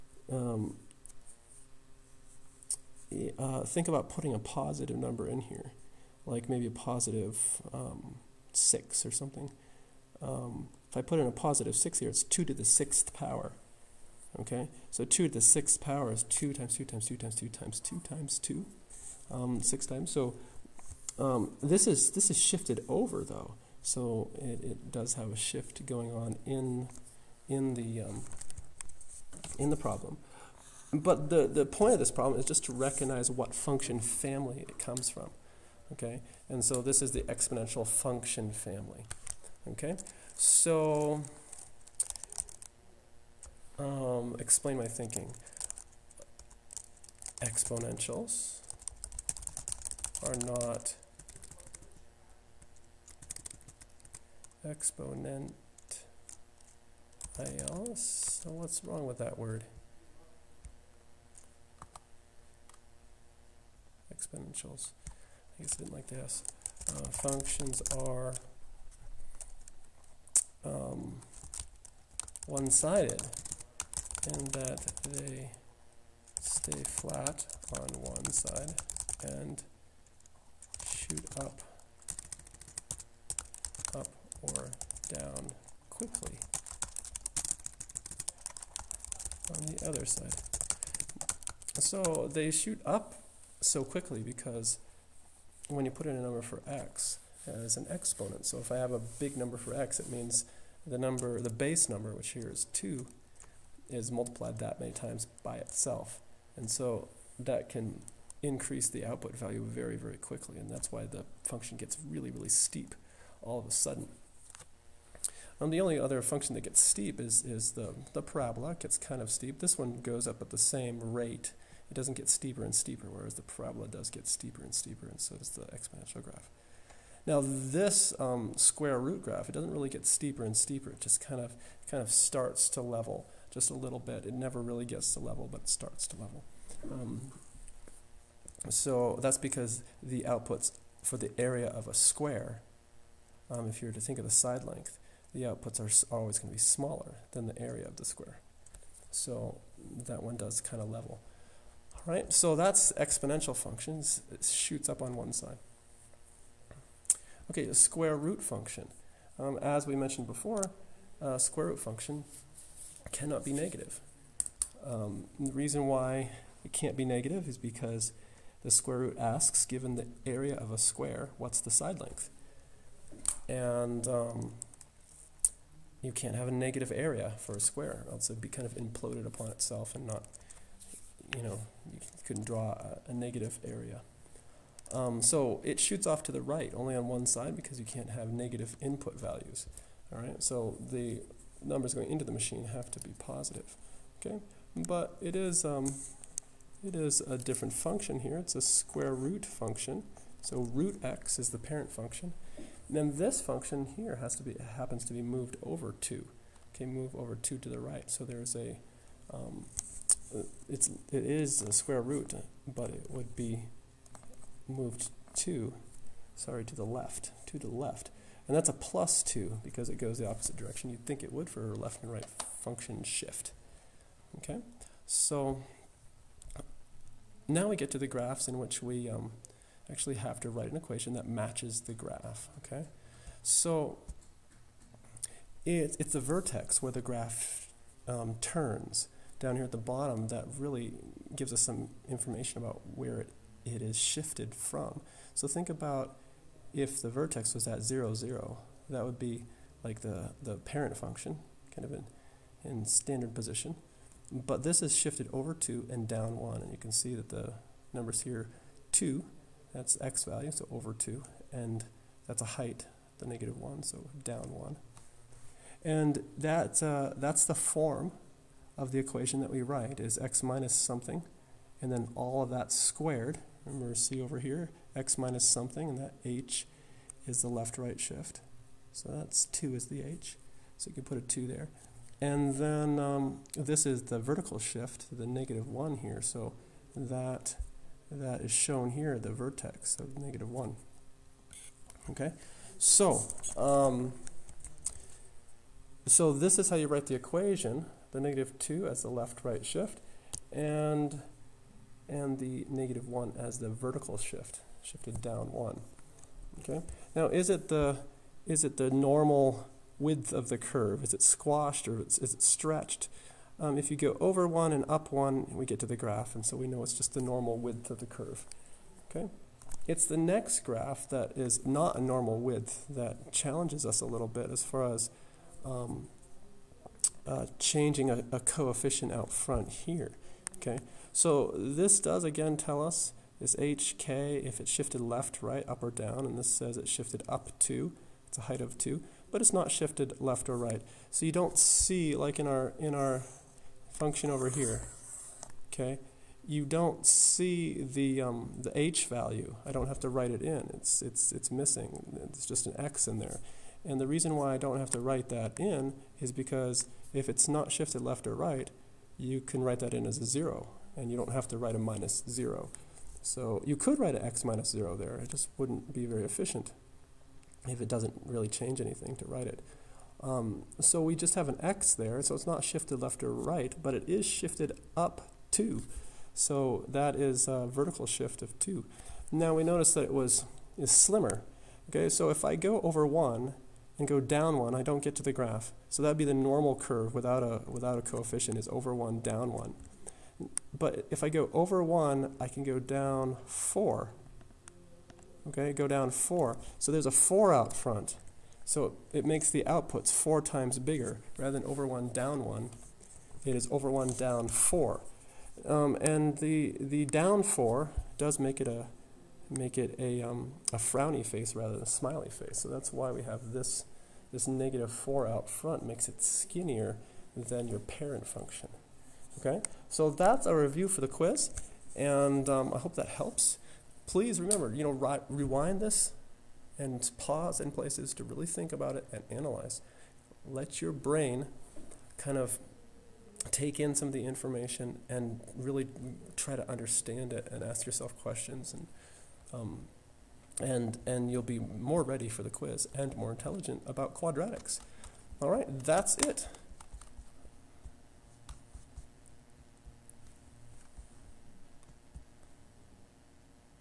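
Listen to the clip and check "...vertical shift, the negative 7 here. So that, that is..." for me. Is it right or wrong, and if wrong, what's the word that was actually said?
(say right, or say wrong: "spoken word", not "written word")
wrong: "1", not "7".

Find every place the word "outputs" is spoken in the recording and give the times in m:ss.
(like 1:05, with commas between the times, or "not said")
1:49, 2:20, 2:25, 6:39.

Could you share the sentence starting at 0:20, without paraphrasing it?
So um, this is this is shifted over, though.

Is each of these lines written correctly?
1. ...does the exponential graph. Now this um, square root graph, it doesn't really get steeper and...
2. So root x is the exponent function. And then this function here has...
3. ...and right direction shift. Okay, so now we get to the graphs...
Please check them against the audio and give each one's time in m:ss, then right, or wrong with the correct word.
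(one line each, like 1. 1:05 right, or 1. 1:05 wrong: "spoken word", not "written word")
1. 2:05 right
2. 3:20 wrong: "parent", not "exponent"
3. 3:42 wrong: "function", not "direction".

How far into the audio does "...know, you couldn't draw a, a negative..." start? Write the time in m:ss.
3:01.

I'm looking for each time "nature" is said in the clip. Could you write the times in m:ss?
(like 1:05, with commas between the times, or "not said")
not said.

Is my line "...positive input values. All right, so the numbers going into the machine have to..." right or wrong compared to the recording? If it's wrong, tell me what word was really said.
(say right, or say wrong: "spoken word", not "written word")
wrong: "negative", not "positive".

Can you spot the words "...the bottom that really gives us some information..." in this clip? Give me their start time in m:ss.
3:59.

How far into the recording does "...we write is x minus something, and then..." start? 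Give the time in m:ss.
4:29.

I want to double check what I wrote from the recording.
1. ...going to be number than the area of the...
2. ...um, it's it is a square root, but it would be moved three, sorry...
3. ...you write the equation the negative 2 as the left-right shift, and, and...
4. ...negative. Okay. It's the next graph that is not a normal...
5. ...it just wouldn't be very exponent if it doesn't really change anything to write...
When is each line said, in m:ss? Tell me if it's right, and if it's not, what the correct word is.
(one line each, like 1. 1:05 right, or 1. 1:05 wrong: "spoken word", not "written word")
1. 2:26 wrong: "smaller", not "number"
2. 3:29 wrong: "two", not "three"
3. 4:56 right
4. 5:18 wrong: "curve", not "negative"
5. 6:05 wrong: "efficient", not "exponent".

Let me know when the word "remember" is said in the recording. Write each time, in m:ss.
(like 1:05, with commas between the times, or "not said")
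4:33, 7:04.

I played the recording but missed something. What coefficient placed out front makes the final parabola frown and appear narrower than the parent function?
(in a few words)
-4.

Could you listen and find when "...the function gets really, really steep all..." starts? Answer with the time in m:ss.
1:51.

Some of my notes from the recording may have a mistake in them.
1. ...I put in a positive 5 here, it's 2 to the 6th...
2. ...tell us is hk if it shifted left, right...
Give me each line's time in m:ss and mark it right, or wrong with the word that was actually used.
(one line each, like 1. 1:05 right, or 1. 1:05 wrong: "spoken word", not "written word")
1. 0:10 wrong: "6", not "5"
2. 5:32 right.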